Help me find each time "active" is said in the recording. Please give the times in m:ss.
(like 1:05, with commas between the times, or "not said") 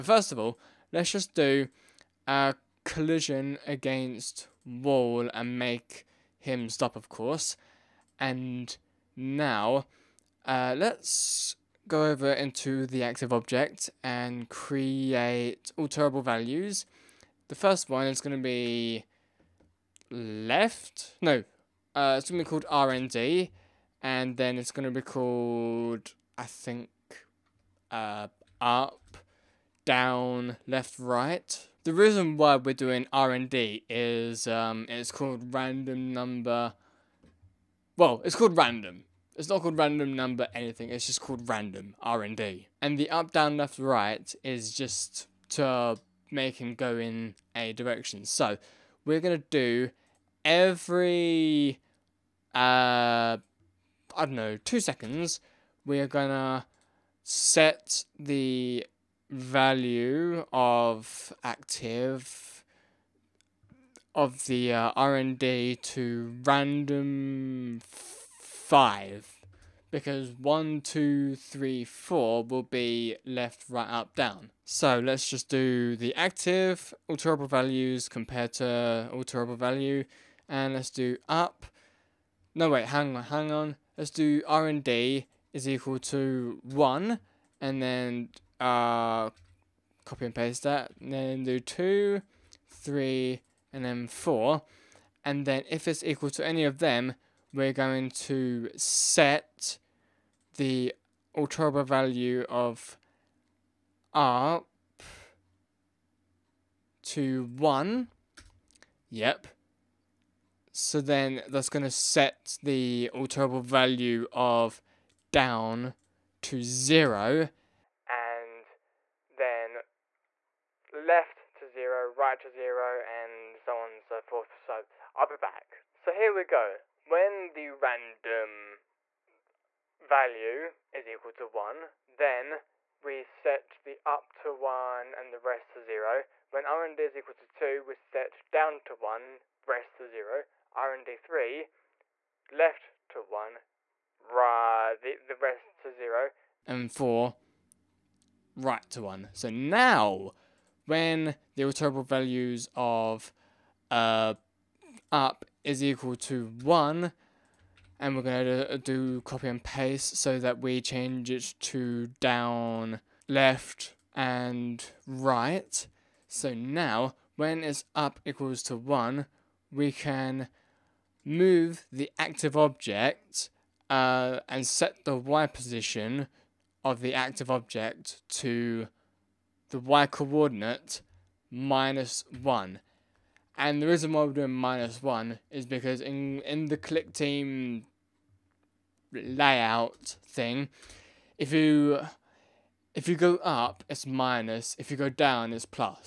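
0:13, 1:01, 1:16, 2:52, 2:57.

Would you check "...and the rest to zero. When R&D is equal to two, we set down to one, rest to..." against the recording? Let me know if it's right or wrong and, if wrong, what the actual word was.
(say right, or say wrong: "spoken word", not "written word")
right.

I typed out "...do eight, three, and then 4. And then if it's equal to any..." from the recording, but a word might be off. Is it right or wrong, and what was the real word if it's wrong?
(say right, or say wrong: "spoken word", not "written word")
wrong: "two", not "eight".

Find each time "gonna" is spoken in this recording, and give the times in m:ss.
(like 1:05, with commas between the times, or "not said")
0:49, 0:56.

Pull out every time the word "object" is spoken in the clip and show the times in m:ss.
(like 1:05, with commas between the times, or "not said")
0:13, 2:52, 2:57.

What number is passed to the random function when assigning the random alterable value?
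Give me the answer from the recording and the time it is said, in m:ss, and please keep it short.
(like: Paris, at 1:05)
5, at 1:08.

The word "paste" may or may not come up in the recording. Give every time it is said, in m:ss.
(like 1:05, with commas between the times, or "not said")
1:30, 2:39.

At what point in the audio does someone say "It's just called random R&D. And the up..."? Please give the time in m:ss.
0:40.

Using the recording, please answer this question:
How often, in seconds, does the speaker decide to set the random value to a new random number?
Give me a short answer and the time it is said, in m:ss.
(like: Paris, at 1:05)
2, at 0:54.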